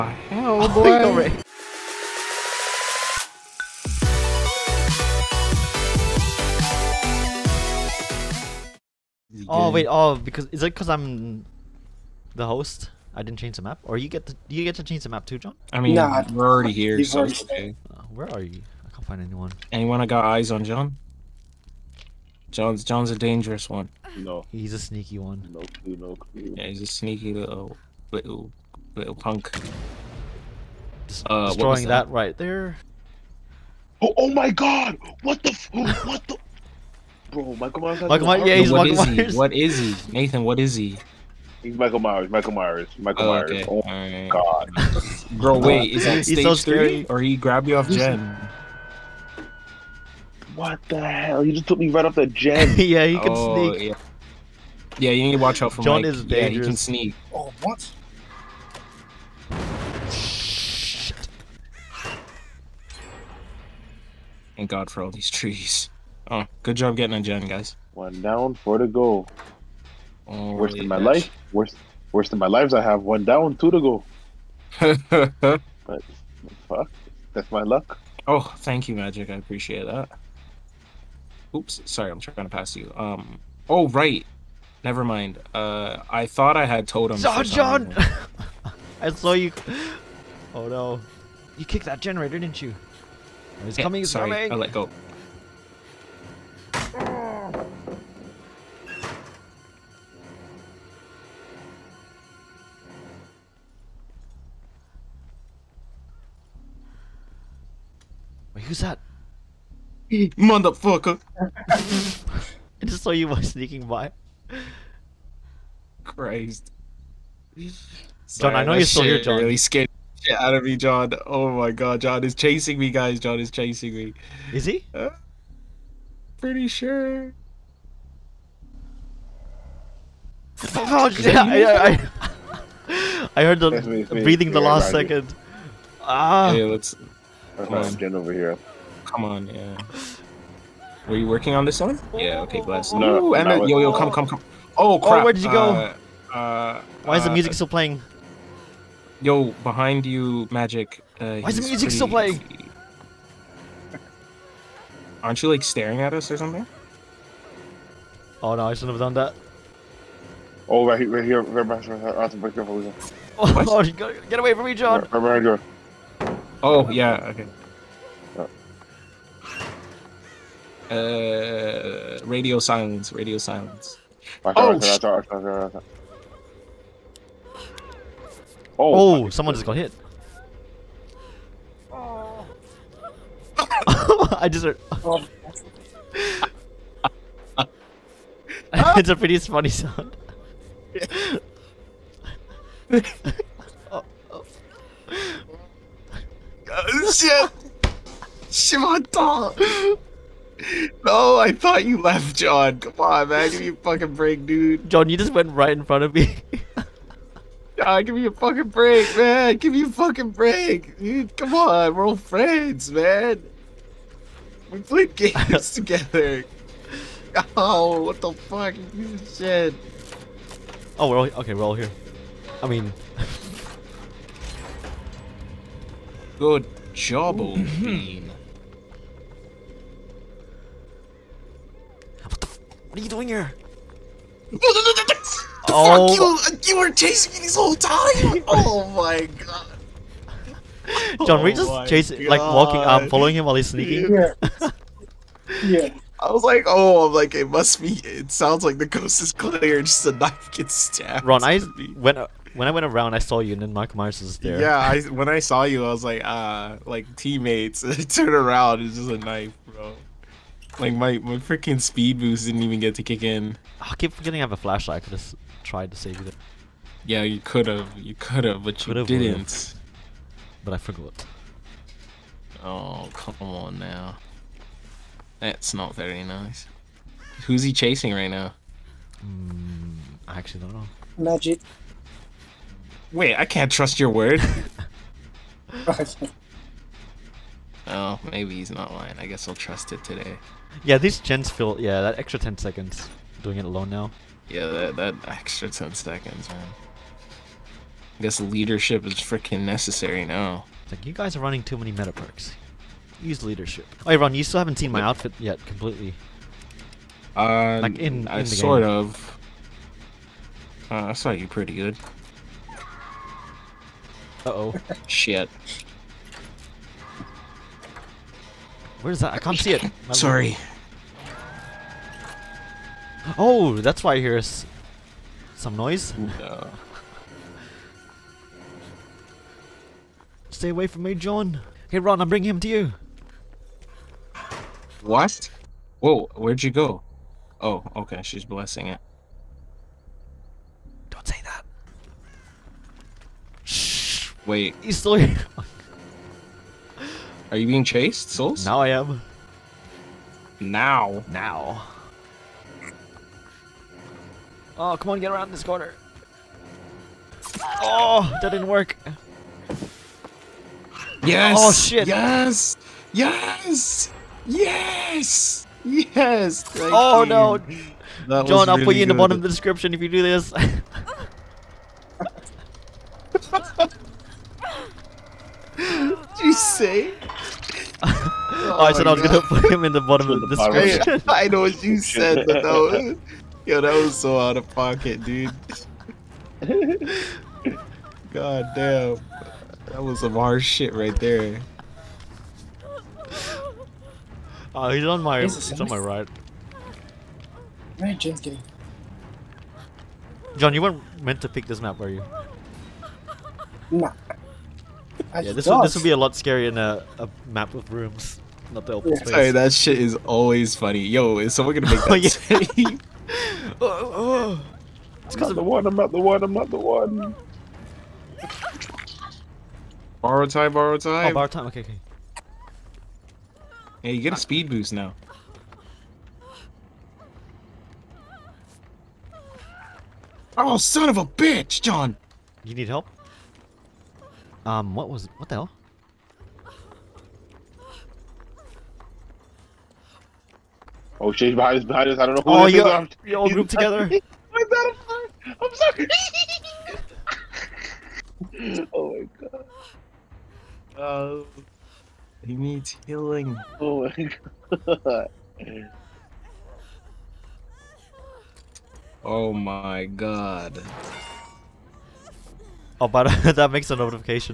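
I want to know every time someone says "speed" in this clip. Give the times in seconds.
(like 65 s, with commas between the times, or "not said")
261 s, 424 s.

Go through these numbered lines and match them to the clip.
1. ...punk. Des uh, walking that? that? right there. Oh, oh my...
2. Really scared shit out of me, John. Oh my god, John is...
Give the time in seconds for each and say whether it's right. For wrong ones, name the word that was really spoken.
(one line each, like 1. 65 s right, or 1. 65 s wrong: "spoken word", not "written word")
1. 29 s wrong: "destroying", not "walking"
2. 119 s right.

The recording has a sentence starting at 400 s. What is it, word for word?
John, you weren't meant to pick this map, were you?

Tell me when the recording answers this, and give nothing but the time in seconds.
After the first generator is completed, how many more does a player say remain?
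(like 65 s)
68 s.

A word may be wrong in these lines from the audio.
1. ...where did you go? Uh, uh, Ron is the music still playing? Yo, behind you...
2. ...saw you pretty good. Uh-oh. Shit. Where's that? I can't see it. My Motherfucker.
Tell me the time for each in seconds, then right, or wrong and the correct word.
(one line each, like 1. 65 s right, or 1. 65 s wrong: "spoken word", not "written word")
1. 145 s wrong: "Why", not "Ron"
2. 311 s wrong: "Sorry", not "Motherfucker".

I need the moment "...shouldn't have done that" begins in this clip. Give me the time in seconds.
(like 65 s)
158 s.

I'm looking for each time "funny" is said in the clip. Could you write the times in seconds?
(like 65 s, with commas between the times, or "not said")
189 s, 410 s.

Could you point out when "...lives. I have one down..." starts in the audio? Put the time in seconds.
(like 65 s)
72 s.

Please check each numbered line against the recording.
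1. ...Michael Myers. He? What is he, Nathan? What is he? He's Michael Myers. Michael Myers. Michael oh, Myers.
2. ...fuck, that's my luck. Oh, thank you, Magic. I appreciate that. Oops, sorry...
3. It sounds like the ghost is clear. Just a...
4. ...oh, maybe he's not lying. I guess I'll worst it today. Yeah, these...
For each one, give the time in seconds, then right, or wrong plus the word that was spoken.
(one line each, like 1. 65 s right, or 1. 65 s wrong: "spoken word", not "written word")
1. 38 s right
2. 76 s right
3. 248 s right
4. 287 s wrong: "trust", not "worst".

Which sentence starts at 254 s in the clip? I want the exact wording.
Yeah, I, when I saw you, I was like, uh, like teammates.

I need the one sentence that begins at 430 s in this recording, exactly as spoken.
Oh, son of a bitch, John!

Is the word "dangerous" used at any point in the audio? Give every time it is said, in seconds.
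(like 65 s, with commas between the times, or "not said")
23 s, 56 s.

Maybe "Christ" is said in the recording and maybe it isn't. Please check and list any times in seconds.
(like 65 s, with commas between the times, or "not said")
116 s.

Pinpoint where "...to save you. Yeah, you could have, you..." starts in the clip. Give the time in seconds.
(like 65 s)
265 s.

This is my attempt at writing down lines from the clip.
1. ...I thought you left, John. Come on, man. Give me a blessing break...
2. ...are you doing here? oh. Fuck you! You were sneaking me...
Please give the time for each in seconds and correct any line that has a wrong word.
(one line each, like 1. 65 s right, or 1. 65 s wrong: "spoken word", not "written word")
1. 201 s wrong: "fucking", not "blessing"
2. 232 s wrong: "chasing", not "sneaking".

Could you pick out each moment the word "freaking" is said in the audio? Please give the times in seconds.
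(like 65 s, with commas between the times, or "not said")
261 s, 299 s.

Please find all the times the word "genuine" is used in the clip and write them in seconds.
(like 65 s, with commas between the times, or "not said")
not said.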